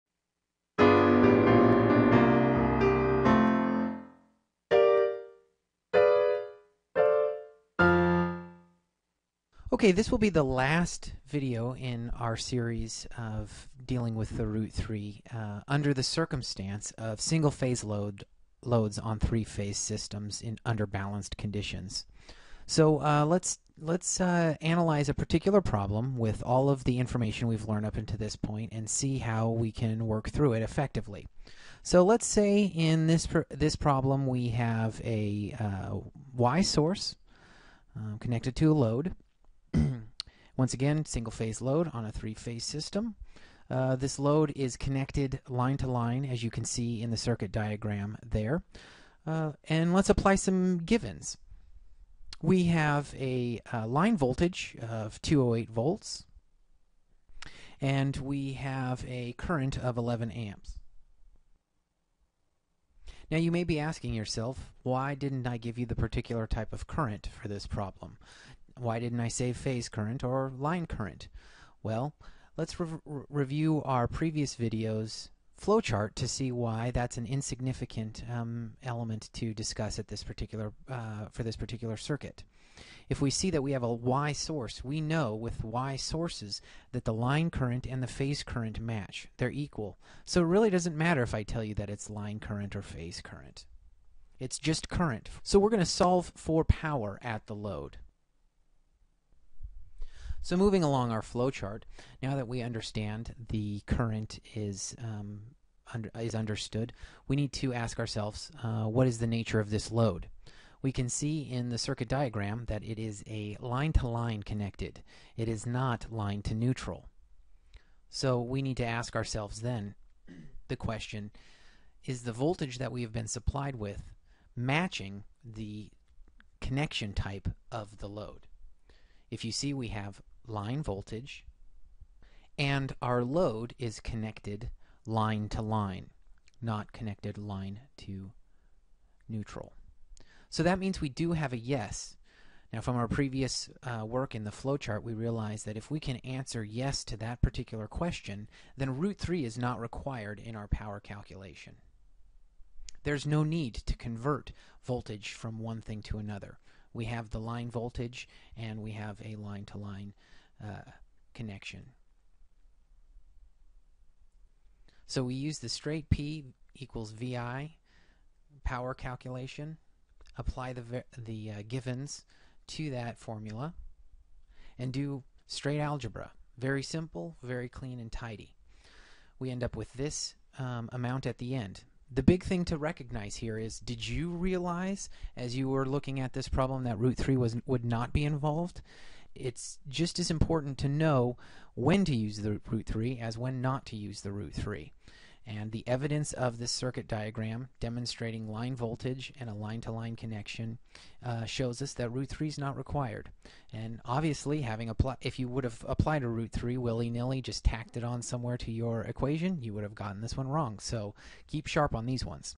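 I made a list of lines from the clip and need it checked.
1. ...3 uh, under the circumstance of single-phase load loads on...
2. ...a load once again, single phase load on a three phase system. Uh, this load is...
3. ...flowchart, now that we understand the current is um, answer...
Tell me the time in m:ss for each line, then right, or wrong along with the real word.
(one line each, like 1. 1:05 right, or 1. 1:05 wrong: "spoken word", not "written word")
1. 0:14 right
2. 0:38 right
3. 1:41 wrong: "under", not "answer".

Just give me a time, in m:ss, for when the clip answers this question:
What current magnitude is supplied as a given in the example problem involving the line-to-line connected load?
0:59.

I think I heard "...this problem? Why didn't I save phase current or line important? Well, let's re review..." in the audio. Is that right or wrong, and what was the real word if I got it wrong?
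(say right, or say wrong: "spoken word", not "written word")
wrong: "current", not "important".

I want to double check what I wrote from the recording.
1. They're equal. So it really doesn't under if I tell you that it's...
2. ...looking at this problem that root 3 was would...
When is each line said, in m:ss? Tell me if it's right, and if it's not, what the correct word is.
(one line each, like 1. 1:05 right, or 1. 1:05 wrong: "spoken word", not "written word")
1. 1:29 wrong: "matter", not "under"
2. 3:05 right.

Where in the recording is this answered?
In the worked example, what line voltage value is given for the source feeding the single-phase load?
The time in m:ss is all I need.
0:55.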